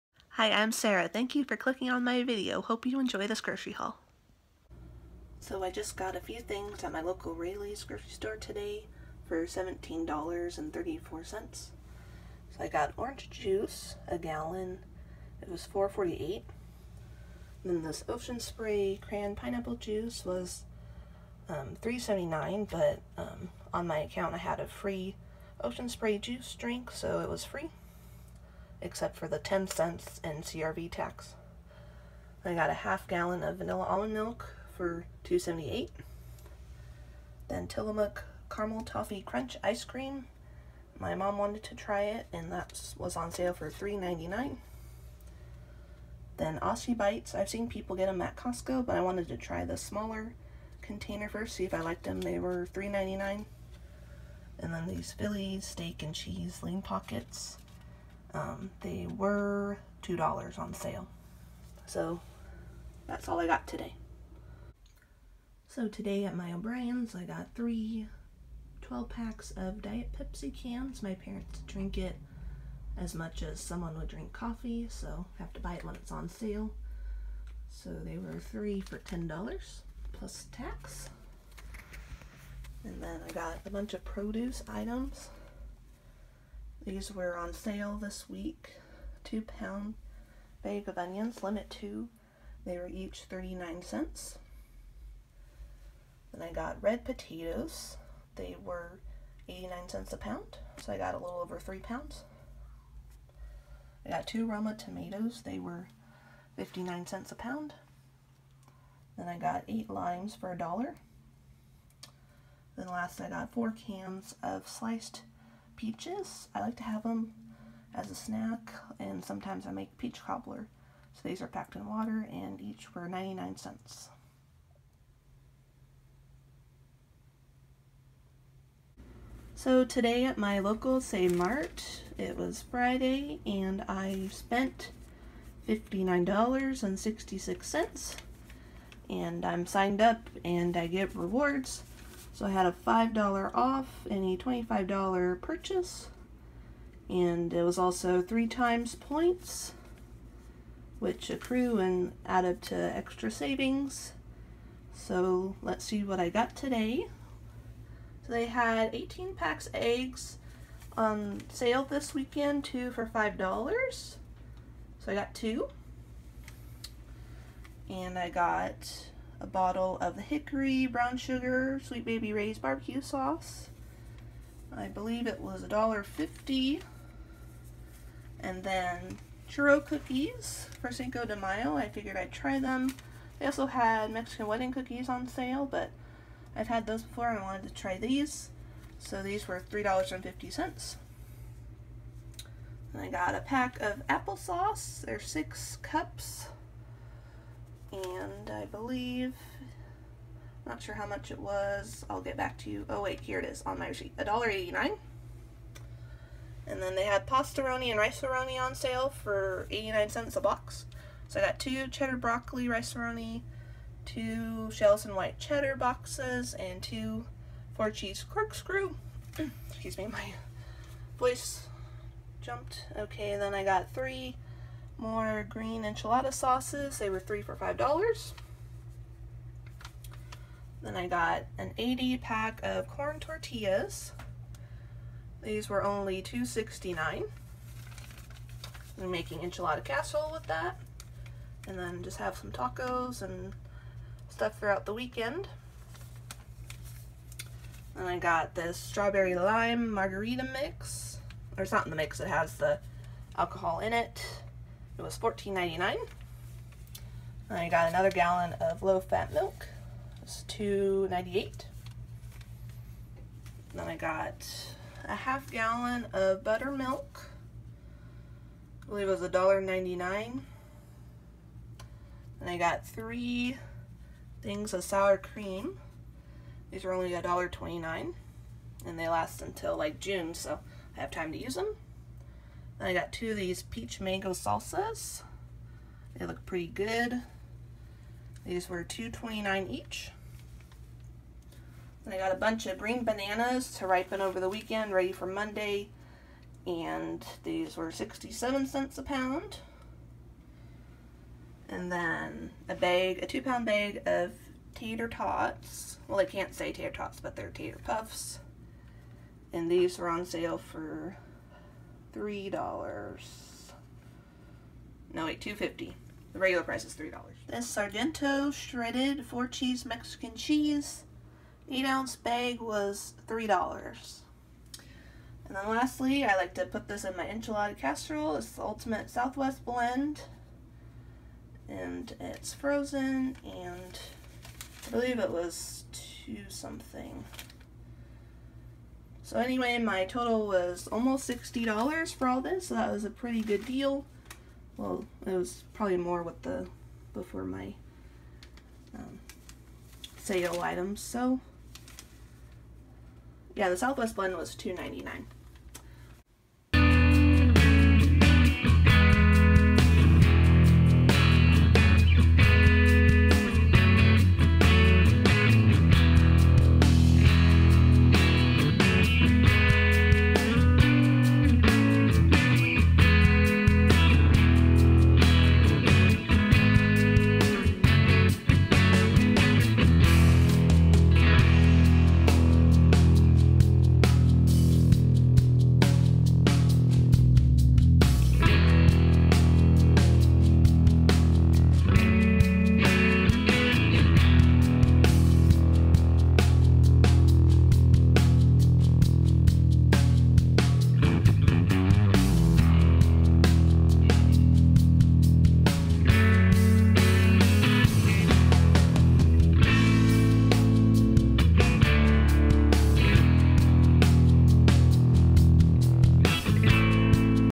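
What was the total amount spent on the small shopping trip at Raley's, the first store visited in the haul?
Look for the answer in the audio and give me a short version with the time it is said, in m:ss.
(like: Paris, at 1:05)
$17.34, at 0:09.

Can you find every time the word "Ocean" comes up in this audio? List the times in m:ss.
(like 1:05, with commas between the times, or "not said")
0:18, 0:25.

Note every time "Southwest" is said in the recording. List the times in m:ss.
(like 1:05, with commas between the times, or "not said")
5:29, 5:53.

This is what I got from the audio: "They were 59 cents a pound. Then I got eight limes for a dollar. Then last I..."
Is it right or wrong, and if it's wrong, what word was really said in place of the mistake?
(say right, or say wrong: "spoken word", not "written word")
right.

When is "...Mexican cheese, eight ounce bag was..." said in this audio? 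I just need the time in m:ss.
5:19.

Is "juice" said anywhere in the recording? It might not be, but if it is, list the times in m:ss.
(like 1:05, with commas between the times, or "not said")
0:13, 0:19, 0:26.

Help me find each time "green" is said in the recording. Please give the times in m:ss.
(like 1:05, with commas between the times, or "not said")
3:45, 4:52.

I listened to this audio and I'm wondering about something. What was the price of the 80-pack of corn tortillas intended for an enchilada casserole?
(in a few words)
$2.69.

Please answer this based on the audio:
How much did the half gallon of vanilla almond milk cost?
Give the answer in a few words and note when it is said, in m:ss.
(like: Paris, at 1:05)
$2.78, at 0:35.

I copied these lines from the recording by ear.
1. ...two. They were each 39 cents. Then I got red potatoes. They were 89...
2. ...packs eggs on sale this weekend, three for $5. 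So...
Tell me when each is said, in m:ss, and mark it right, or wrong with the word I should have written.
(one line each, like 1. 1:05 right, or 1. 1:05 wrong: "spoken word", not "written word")
1. 1:31 right
2. 2:39 wrong: "two", not "three".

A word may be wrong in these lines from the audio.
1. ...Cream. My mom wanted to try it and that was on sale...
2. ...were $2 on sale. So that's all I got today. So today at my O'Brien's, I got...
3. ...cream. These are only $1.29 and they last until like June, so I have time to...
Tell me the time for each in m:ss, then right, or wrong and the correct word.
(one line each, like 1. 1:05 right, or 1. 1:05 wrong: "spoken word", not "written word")
1. 0:39 right
2. 0:59 right
3. 4:35 right.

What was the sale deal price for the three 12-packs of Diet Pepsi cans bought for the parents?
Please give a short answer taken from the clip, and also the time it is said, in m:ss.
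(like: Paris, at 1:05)
3 for $10, at 1:18.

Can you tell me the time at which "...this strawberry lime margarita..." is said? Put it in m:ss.
4:08.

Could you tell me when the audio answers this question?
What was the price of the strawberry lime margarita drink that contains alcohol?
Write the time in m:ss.
4:15.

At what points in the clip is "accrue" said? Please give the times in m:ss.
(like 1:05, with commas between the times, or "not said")
2:31.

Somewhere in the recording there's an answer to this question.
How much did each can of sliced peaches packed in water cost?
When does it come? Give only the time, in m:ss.
2:03.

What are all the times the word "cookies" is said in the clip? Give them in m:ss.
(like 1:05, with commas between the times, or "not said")
2:59, 3:04.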